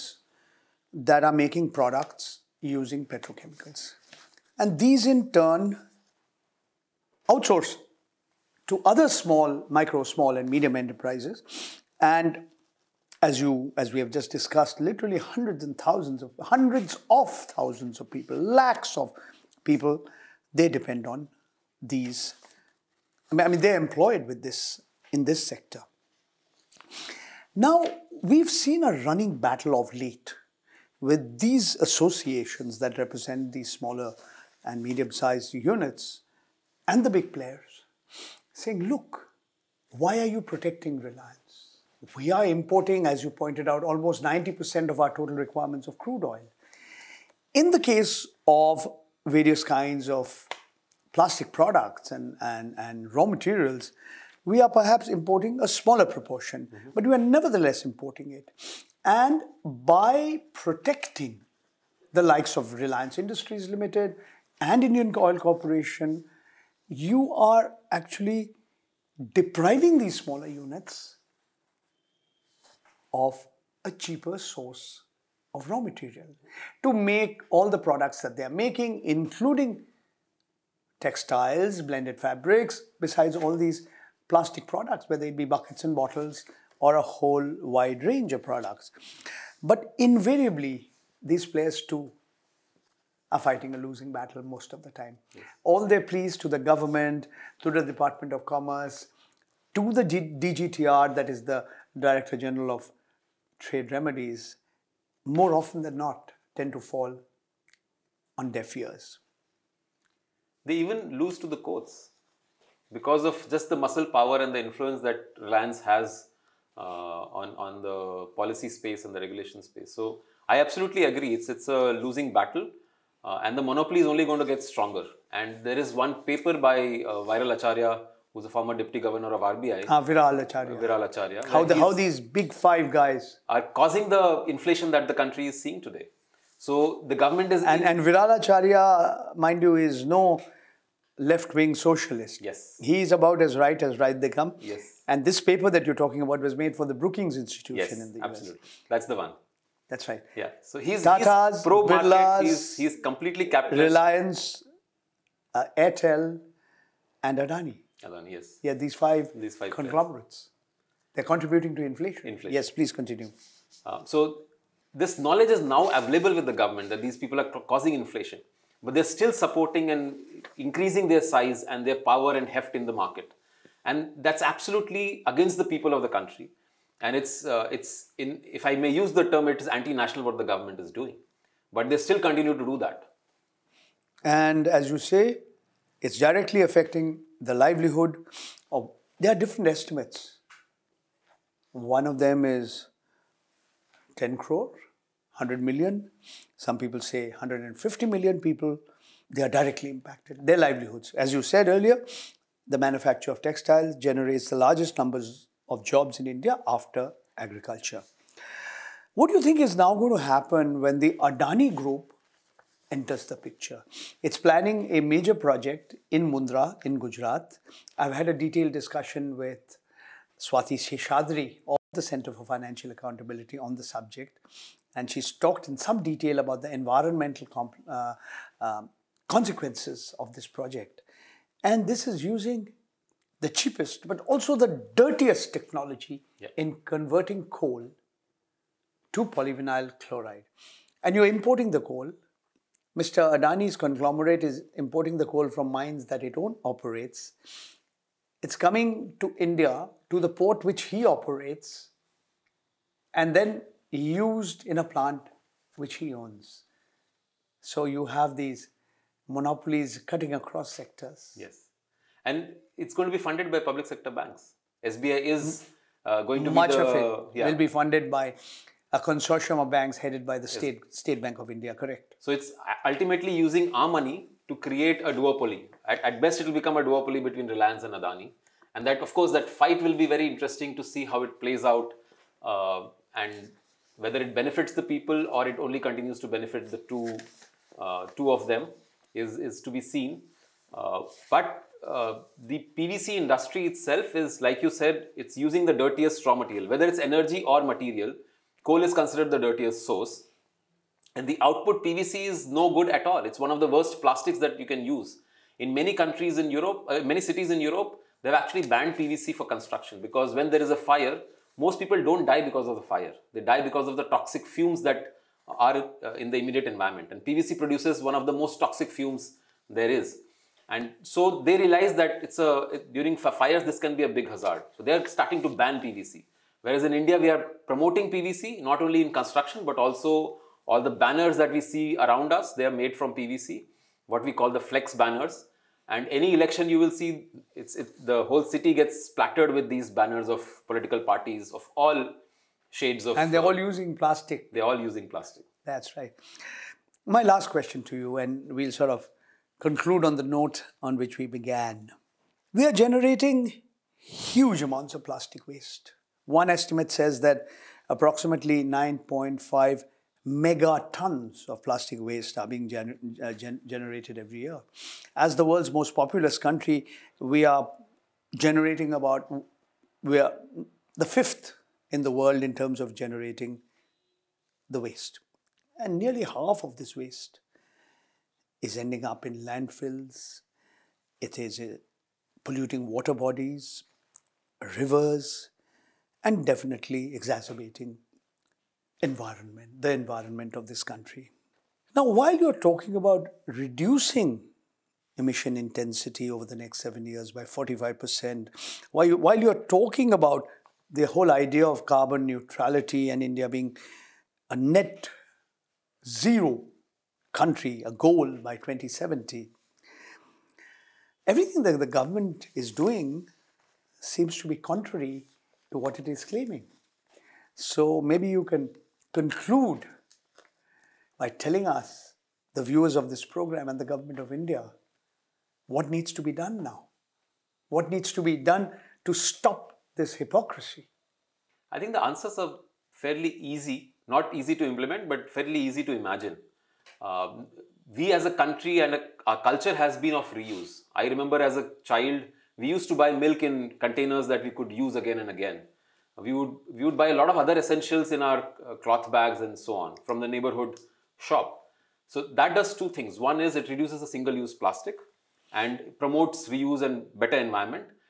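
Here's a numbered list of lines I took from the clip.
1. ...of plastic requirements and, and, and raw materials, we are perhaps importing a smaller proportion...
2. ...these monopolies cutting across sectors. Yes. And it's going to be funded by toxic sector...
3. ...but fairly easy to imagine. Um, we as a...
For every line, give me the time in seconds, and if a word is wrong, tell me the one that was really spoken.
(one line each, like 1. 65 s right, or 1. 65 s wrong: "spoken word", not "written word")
1. 50 s wrong: "products", not "requirements"
2. 258 s wrong: "public", not "toxic"
3. 435 s right.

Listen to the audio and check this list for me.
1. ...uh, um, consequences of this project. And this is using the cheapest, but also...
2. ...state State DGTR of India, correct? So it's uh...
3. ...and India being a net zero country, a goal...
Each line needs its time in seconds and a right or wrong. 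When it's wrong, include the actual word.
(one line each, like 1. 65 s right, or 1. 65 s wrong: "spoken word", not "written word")
1. 227 s right
2. 270 s wrong: "Bank", not "DGTR"
3. 403 s right.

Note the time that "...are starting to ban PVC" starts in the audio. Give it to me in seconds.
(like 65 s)
324 s.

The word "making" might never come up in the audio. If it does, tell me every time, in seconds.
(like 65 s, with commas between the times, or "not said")
1 s, 78 s.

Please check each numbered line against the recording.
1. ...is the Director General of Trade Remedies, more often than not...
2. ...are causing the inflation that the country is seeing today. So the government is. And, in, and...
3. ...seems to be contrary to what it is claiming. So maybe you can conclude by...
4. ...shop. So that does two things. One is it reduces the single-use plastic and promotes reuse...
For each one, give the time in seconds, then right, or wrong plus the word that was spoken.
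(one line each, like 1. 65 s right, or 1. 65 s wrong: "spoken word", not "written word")
1. 101 s right
2. 133 s right
3. 414 s right
4. 451 s right.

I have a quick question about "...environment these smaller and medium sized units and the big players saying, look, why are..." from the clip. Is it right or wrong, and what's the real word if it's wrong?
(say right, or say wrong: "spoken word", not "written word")
wrong: "represent", not "environment".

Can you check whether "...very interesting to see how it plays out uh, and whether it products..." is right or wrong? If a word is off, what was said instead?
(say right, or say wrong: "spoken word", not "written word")
wrong: "benefits", not "products".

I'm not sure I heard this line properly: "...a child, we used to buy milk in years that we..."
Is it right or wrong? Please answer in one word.
wrong.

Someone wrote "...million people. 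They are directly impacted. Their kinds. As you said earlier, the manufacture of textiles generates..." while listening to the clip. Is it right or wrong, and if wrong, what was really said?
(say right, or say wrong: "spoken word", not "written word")
wrong: "livelihoods", not "kinds".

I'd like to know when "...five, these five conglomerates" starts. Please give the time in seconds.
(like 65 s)
158 s.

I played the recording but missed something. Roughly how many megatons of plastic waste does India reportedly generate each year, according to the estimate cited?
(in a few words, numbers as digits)
9.5.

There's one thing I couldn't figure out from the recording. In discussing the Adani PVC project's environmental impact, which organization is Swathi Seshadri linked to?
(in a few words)
Center for Financial Accountability.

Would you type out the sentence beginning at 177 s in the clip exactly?
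And it's, uh, it's in, if I may use the term, it is anti-national what the government is doing.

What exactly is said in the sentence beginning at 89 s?
But invariably, these players too are fighting a losing battle most of the time.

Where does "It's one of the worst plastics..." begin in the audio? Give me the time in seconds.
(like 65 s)
303 s.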